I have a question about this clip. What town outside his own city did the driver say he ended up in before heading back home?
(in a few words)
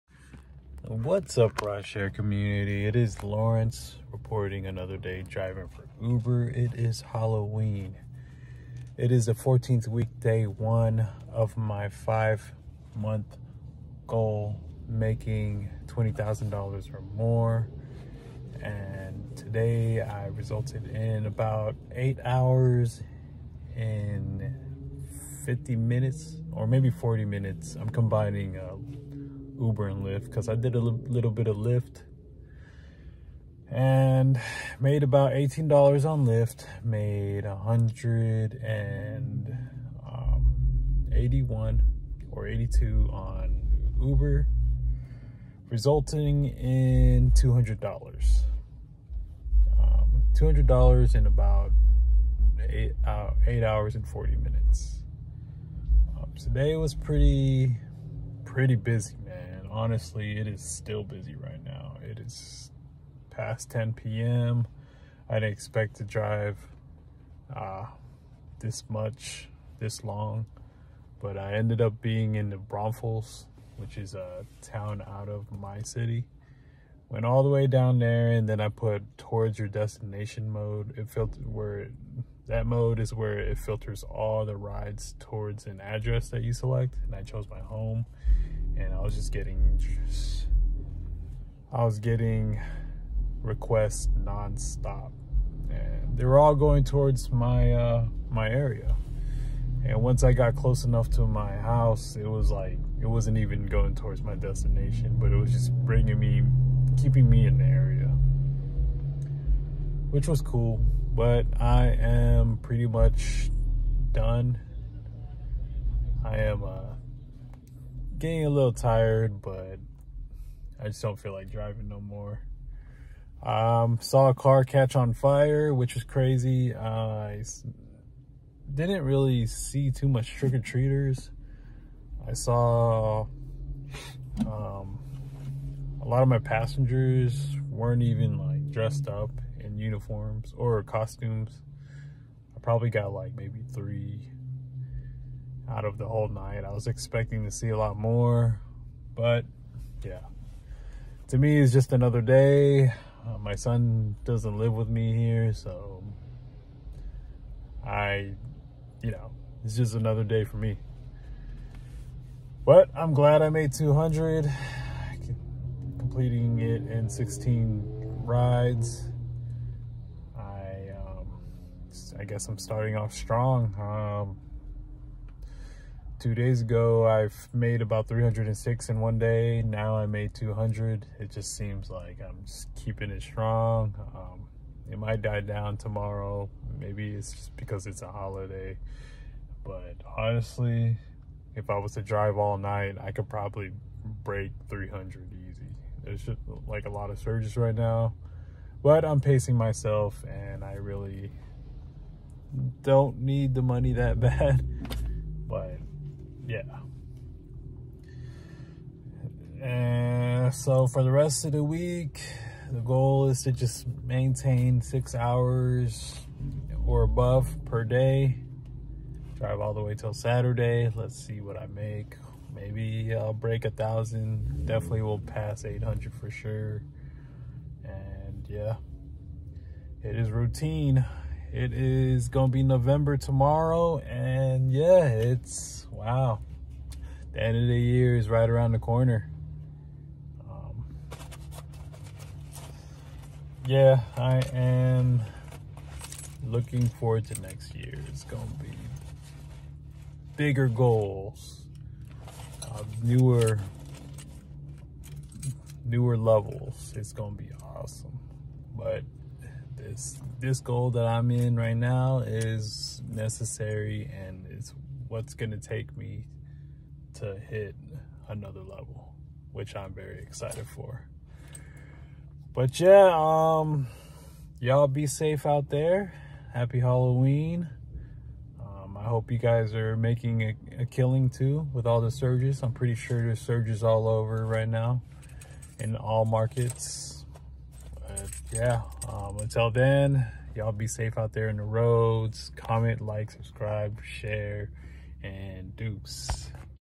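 Braunfels.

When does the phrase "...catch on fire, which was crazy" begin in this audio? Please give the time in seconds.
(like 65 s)
124 s.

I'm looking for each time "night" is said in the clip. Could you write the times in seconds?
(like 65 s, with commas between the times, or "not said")
146 s, 192 s.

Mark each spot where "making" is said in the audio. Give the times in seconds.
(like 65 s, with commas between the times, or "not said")
14 s, 279 s.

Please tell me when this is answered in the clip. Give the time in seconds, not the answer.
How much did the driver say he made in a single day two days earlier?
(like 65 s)
178 s.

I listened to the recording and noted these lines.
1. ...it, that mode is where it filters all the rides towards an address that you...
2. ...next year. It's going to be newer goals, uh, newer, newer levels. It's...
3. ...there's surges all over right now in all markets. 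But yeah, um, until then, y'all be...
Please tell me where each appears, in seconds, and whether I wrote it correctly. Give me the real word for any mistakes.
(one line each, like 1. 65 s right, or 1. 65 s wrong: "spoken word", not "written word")
1. 81 s right
2. 247 s wrong: "bigger", not "newer"
3. 283 s right.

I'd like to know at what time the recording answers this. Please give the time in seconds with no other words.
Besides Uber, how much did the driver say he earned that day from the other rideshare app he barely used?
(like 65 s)
35 s.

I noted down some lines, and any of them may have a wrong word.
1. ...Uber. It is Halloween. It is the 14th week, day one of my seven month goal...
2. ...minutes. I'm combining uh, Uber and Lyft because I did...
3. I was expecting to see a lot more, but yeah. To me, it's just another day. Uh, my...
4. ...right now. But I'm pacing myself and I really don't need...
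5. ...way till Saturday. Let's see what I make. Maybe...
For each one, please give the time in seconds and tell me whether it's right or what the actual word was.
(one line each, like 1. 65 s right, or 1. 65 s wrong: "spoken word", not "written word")
1. 6 s wrong: "five", not "seven"
2. 27 s right
3. 146 s right
4. 197 s right
5. 219 s right.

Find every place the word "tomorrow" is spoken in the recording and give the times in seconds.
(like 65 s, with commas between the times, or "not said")
185 s, 233 s.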